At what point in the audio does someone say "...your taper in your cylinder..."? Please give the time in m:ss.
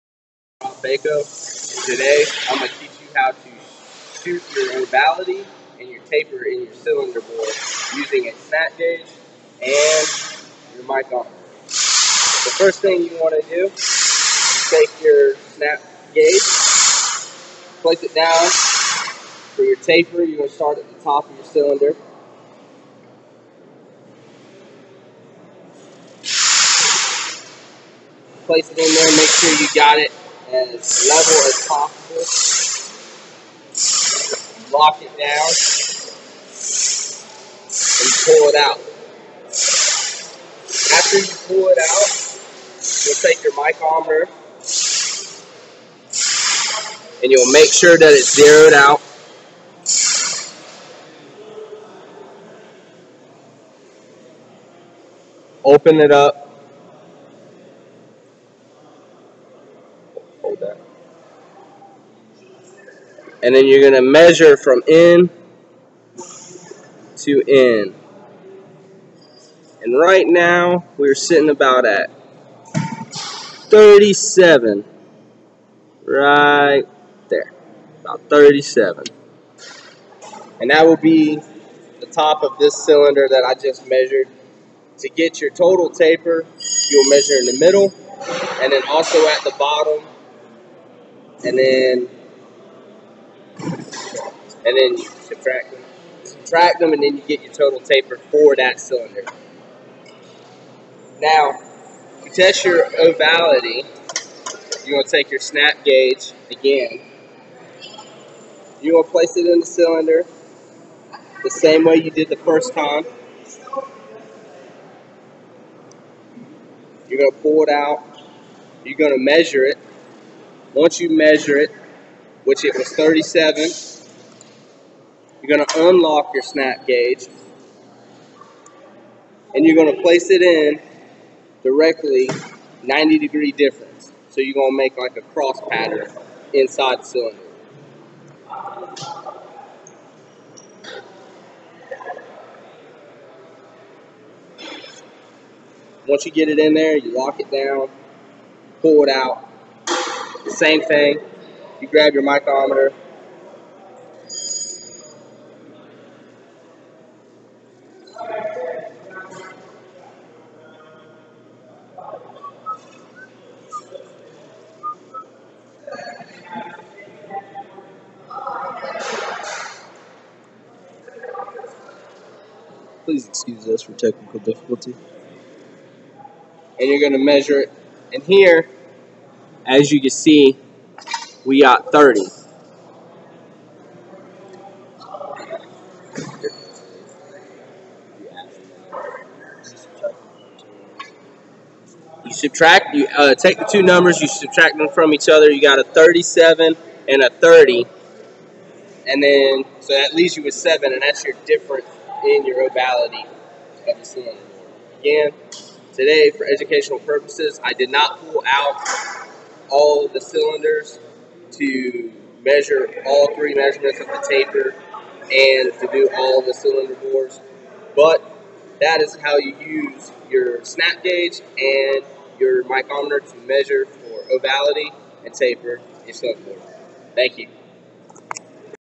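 0:05.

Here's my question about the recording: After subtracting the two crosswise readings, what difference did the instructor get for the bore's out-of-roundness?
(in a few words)
7.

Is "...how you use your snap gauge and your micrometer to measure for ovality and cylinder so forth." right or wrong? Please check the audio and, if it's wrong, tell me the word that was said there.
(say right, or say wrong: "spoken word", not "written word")
wrong: "taper", not "cylinder".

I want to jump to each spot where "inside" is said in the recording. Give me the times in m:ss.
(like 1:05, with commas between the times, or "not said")
2:16.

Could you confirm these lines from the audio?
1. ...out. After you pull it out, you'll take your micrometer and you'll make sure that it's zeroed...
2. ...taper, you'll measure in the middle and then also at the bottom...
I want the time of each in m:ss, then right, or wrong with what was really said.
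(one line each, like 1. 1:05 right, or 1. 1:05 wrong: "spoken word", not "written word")
1. 0:38 right
2. 1:25 right.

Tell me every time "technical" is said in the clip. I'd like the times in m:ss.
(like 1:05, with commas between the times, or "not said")
2:53.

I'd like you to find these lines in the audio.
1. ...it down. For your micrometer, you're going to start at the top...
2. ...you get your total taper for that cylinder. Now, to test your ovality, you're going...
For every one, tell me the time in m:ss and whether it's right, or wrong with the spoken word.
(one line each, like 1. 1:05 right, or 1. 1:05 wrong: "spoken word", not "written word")
1. 0:18 wrong: "taper", not "micrometer"
2. 1:37 right.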